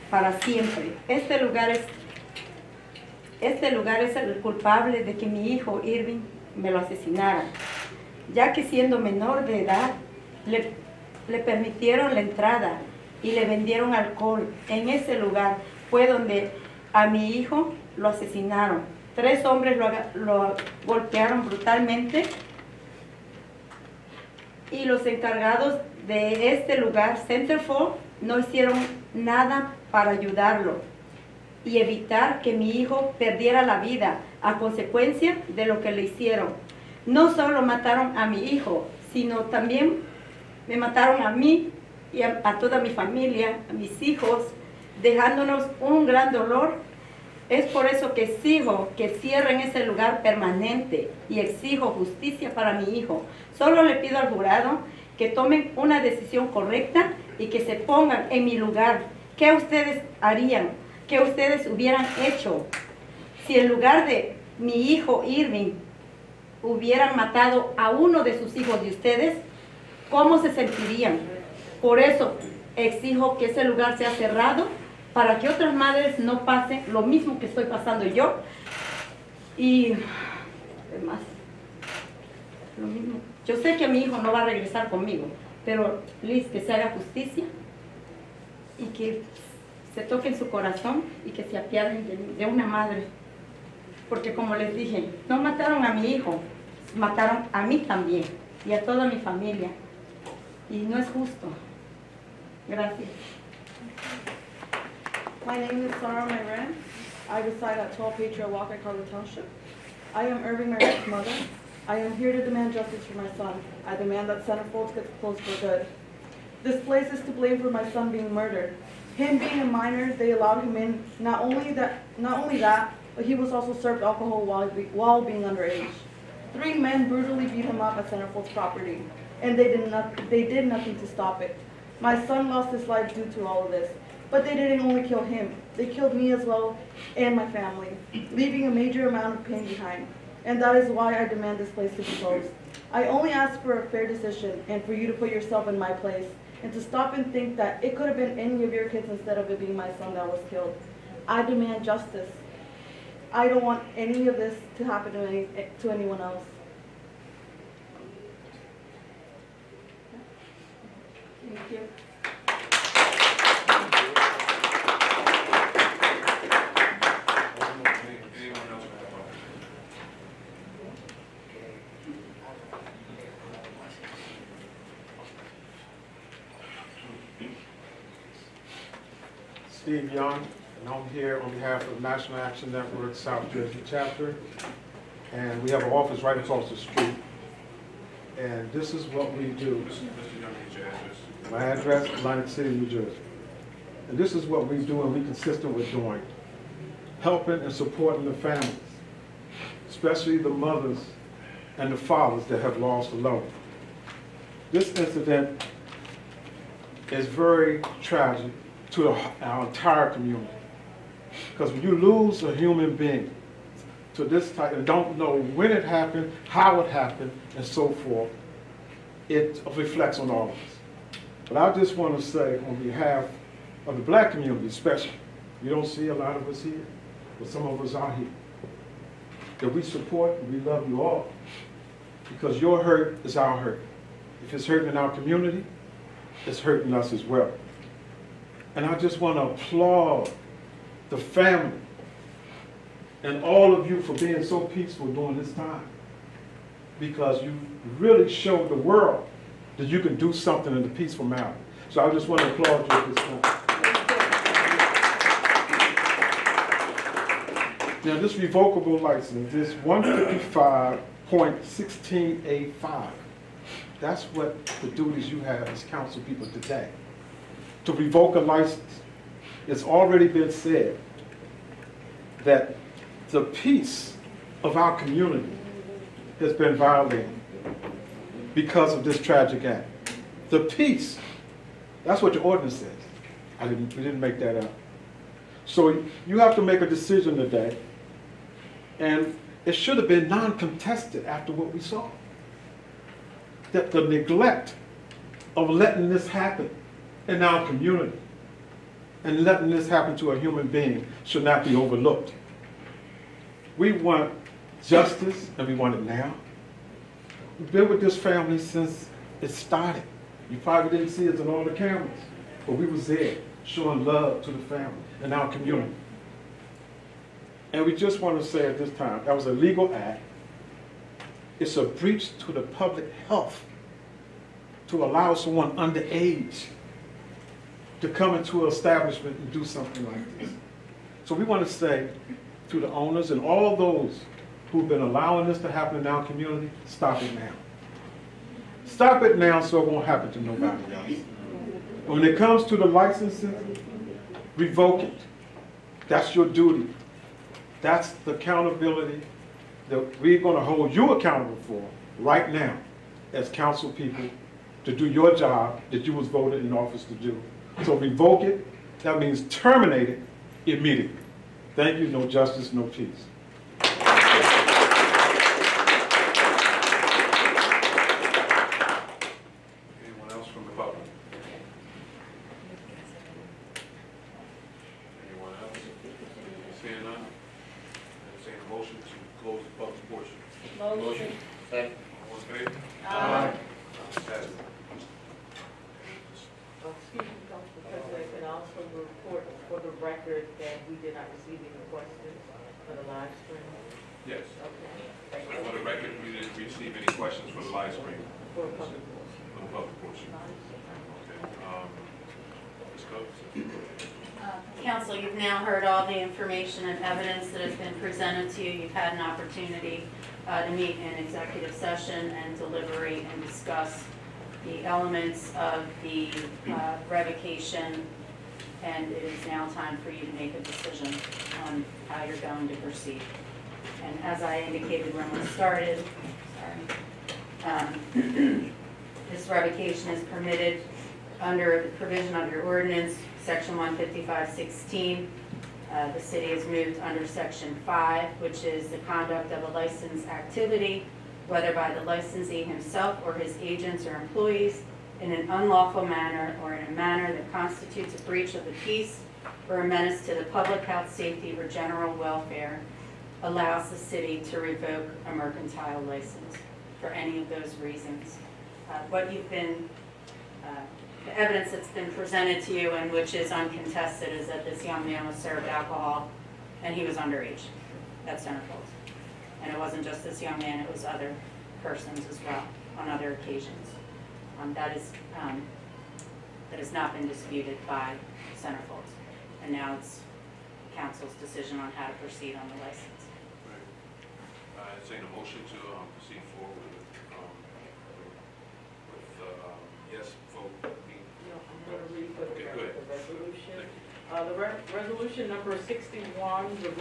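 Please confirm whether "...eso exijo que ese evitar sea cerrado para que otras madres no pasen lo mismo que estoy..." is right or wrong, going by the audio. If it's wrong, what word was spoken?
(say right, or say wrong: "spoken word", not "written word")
wrong: "lugar", not "evitar".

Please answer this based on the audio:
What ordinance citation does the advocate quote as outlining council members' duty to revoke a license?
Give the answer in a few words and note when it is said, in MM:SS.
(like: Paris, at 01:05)
155.16A5, at 04:19.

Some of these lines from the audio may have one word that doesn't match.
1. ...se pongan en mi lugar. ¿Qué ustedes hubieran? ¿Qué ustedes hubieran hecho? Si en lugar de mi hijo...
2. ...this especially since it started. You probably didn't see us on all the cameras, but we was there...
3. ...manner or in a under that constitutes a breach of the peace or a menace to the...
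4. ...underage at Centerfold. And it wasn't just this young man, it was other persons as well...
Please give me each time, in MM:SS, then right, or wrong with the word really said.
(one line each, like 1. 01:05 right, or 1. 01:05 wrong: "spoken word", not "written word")
1. 00:57 wrong: "harían", not "hubieran"
2. 05:08 wrong: "family", not "especially"
3. 07:26 wrong: "manner", not "under"
4. 07:47 right.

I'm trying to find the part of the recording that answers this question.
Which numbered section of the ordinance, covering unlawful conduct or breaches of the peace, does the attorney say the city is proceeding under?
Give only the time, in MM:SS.
07:17.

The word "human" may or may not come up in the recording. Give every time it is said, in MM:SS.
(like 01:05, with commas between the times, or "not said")
03:32, 05:00.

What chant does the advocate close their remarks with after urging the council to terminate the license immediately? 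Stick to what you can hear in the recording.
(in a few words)
No justice, no peace.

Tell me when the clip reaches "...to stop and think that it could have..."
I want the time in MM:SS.
02:26.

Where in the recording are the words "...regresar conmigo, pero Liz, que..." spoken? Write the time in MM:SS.
01:24.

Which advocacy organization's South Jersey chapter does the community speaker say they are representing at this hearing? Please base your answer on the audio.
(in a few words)
National Action Network.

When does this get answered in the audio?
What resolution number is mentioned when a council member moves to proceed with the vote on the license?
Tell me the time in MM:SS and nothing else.
08:15.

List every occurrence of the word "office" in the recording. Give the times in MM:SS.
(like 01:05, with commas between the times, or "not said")
03:05, 05:56.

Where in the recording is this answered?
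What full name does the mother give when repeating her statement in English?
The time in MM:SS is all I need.
01:45.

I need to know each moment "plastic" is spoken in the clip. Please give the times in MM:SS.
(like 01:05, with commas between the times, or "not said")
not said.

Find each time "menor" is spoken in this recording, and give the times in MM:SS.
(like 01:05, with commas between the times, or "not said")
00:08.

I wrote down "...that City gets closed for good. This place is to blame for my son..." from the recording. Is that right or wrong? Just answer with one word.
wrong.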